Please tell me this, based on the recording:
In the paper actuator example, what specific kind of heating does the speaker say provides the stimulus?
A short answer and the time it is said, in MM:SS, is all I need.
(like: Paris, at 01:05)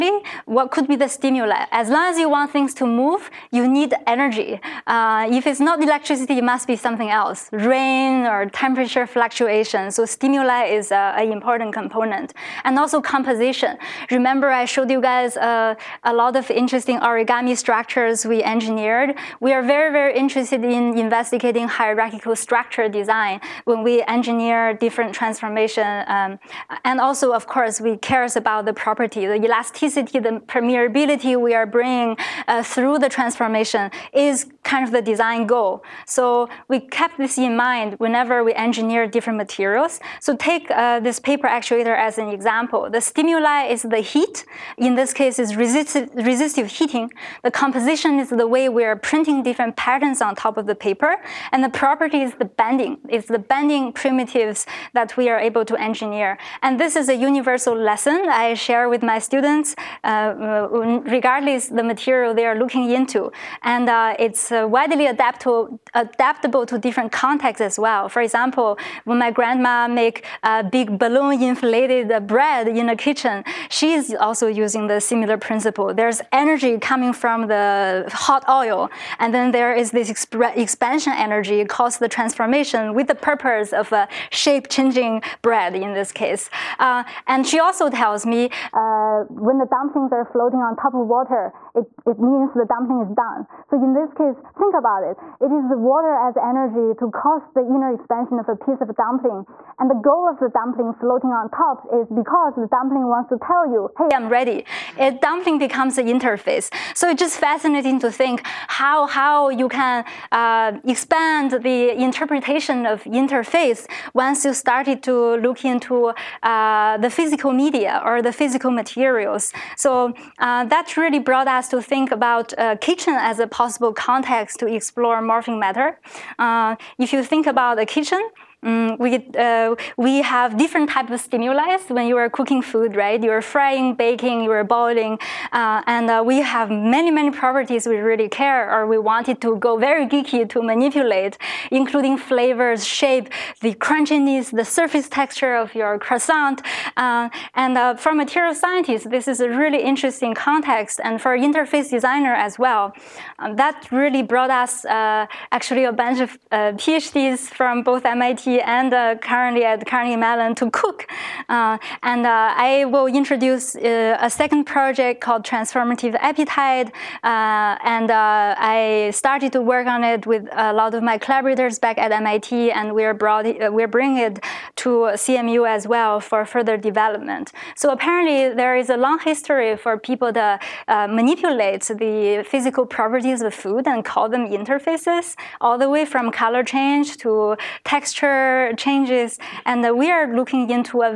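Resistive heating, at 00:46.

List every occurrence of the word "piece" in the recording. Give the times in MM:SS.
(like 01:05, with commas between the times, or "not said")
01:38.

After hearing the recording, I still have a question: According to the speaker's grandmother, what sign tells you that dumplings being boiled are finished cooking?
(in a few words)
Floating on top of water.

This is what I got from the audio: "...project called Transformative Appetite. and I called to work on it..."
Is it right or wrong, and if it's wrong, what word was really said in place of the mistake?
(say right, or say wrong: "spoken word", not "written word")
wrong: "started", not "called".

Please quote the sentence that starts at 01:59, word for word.
So uh, that really brought us to think about uh, kitchen as a possible context to explore morphing matter.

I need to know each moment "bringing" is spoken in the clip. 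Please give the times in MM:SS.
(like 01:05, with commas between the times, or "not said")
00:31, 02:53.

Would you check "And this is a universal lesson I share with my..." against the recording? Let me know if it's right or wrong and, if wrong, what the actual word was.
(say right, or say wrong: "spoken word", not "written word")
right.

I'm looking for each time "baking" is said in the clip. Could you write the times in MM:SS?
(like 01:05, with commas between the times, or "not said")
02:13.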